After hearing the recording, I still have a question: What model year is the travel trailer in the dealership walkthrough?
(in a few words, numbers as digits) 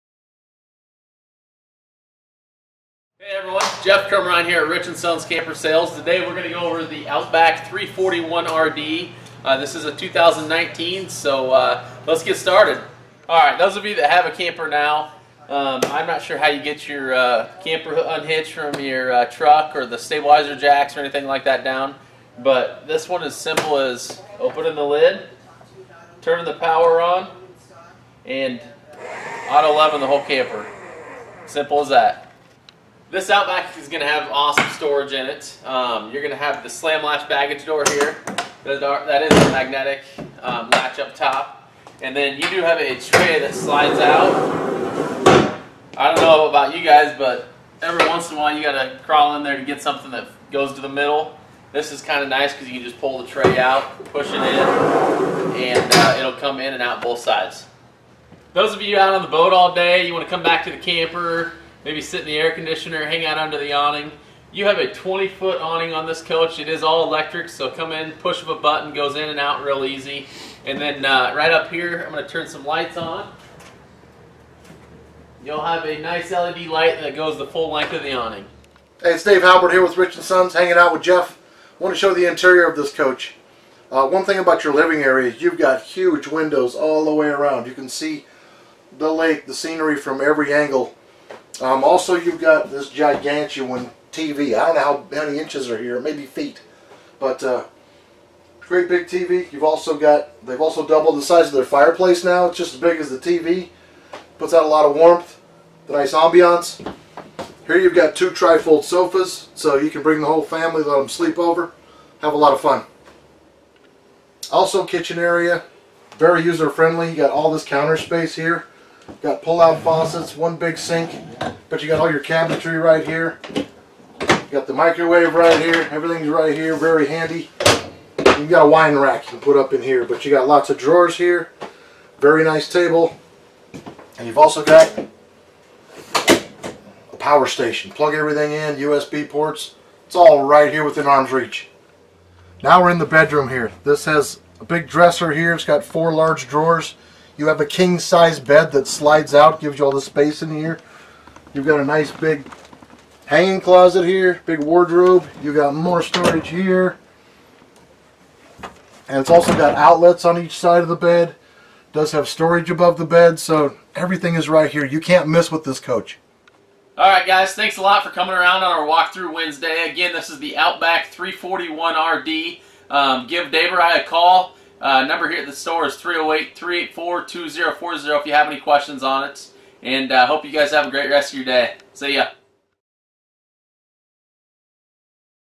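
2019.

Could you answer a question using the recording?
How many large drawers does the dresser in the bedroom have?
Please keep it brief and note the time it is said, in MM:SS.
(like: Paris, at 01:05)
4, at 02:25.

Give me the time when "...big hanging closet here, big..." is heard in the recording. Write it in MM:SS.
02:32.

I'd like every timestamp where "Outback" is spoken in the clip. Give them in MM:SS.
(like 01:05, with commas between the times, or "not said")
00:07, 00:33, 02:50.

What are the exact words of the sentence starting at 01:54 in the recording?
Also kitchen area, very user friendly.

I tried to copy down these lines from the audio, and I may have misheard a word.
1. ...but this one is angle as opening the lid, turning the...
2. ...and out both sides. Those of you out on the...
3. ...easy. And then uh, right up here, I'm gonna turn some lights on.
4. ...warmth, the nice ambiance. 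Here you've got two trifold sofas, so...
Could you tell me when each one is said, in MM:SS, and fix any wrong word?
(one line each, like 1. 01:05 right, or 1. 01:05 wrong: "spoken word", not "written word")
1. 00:22 wrong: "simple", not "angle"
2. 00:56 right
3. 01:09 right
4. 01:44 right.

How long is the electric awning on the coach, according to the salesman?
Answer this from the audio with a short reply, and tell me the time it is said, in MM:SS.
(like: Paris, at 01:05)
20 foot, at 01:04.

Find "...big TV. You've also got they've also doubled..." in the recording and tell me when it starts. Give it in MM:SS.
01:38.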